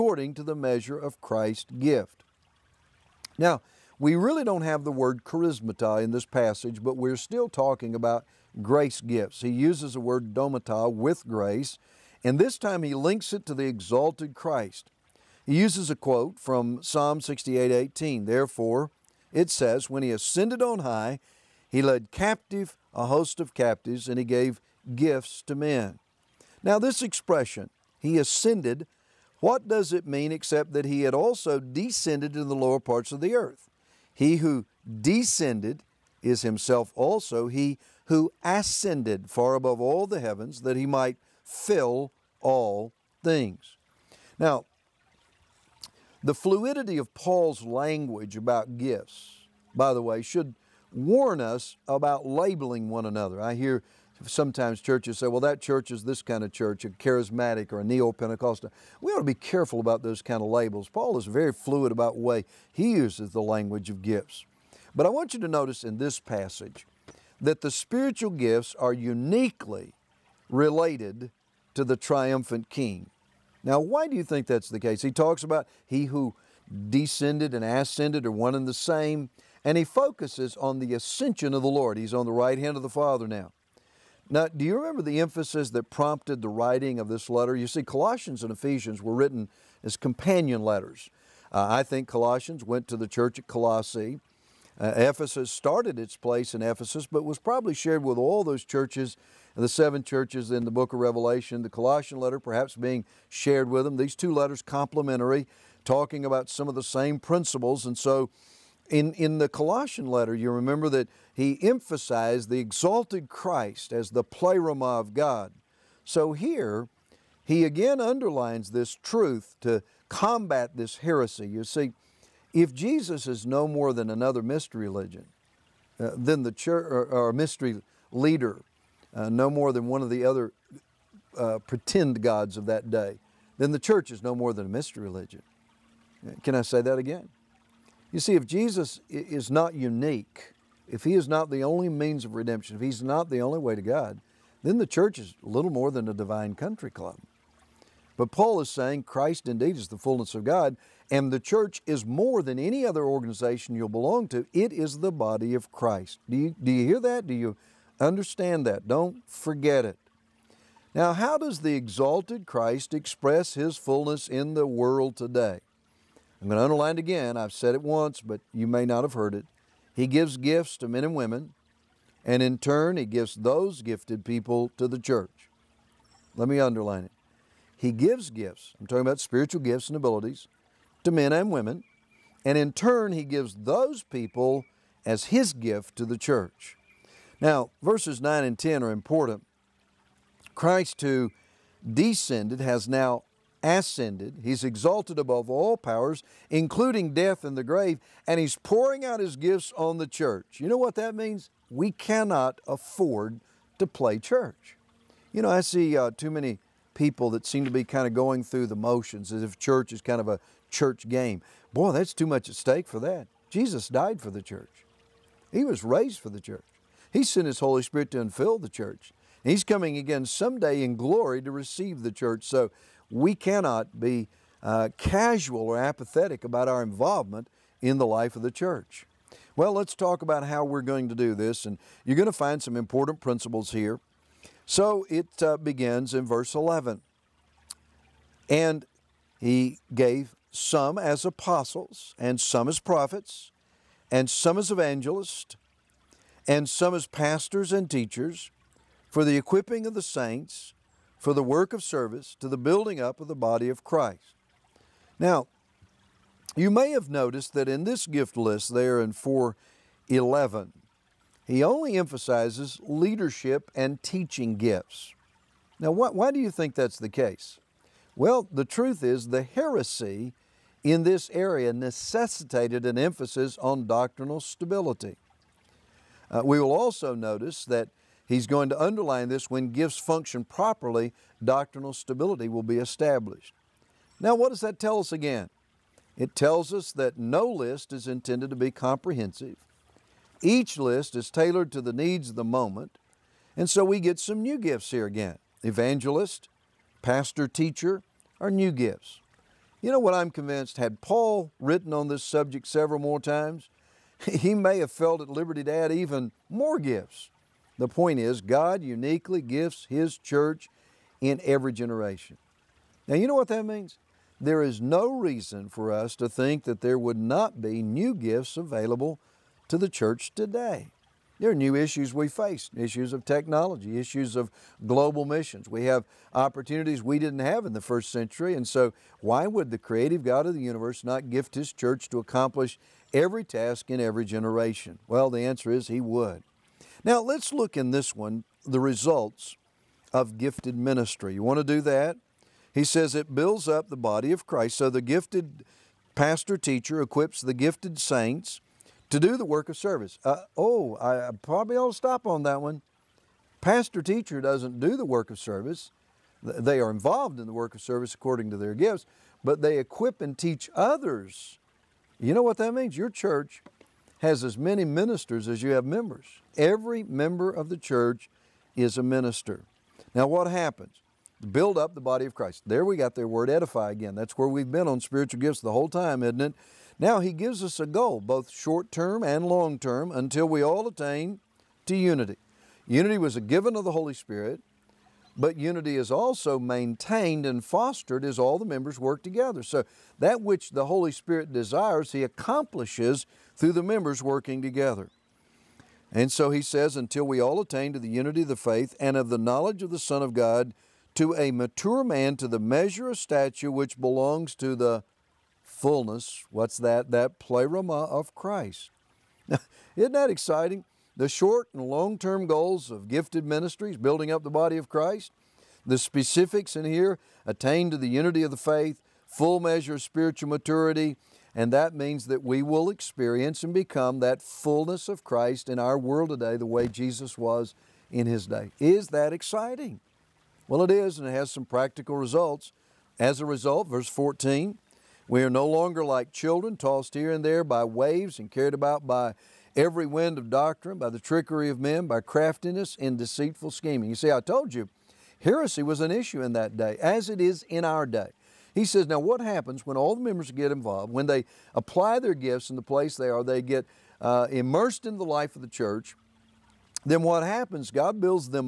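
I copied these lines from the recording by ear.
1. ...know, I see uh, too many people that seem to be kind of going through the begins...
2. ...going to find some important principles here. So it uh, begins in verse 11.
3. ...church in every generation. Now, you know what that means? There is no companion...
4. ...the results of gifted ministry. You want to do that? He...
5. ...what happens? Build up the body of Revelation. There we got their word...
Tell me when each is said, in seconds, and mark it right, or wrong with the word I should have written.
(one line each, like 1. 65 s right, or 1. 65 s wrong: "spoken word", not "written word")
1. 205 s wrong: "motions", not "begins"
2. 232 s right
3. 310 s wrong: "reason", not "companion"
4. 338 s right
5. 370 s wrong: "Christ", not "Revelation".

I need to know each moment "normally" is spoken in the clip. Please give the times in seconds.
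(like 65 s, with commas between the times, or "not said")
not said.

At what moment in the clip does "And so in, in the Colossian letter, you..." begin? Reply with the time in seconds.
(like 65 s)
107 s.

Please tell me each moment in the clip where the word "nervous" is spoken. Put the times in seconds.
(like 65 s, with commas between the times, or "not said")
not said.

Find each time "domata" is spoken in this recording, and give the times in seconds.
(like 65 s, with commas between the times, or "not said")
10 s.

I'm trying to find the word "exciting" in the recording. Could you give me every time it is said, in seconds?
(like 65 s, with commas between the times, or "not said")
410 s, 429 s.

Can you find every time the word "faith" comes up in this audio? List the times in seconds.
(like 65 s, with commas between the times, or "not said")
398 s, 418 s.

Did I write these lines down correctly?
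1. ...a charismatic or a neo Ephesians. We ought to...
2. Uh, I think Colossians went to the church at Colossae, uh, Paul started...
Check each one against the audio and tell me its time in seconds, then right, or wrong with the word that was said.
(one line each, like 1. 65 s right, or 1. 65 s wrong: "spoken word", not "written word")
1. 56 s wrong: "Pentecostal", not "Ephesians"
2. 91 s wrong: "Ephesus", not "Paul".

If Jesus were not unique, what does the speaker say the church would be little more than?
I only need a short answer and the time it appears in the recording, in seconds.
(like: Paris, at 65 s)
a divine country club, at 146 s.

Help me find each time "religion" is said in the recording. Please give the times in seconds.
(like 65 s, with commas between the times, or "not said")
124 s, 135 s.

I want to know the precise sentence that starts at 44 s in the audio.
Now, the fluidity of Paul's language about gifts, by the way, should warn us about labeling one another.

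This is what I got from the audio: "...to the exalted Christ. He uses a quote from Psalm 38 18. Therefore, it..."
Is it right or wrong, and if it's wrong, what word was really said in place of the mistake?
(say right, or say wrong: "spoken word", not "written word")
wrong: "68", not "38".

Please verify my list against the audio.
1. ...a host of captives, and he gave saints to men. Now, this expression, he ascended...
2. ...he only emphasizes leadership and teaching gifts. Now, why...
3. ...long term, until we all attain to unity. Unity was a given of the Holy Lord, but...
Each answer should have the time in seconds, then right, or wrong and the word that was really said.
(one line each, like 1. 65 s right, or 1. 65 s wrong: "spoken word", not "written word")
1. 22 s wrong: "gifts", not "saints"
2. 261 s right
3. 379 s wrong: "Spirit", not "Lord".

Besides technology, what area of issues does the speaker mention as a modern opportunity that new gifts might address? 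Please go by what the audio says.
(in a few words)
global missions.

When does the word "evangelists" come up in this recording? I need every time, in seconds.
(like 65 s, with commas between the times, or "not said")
244 s, 295 s.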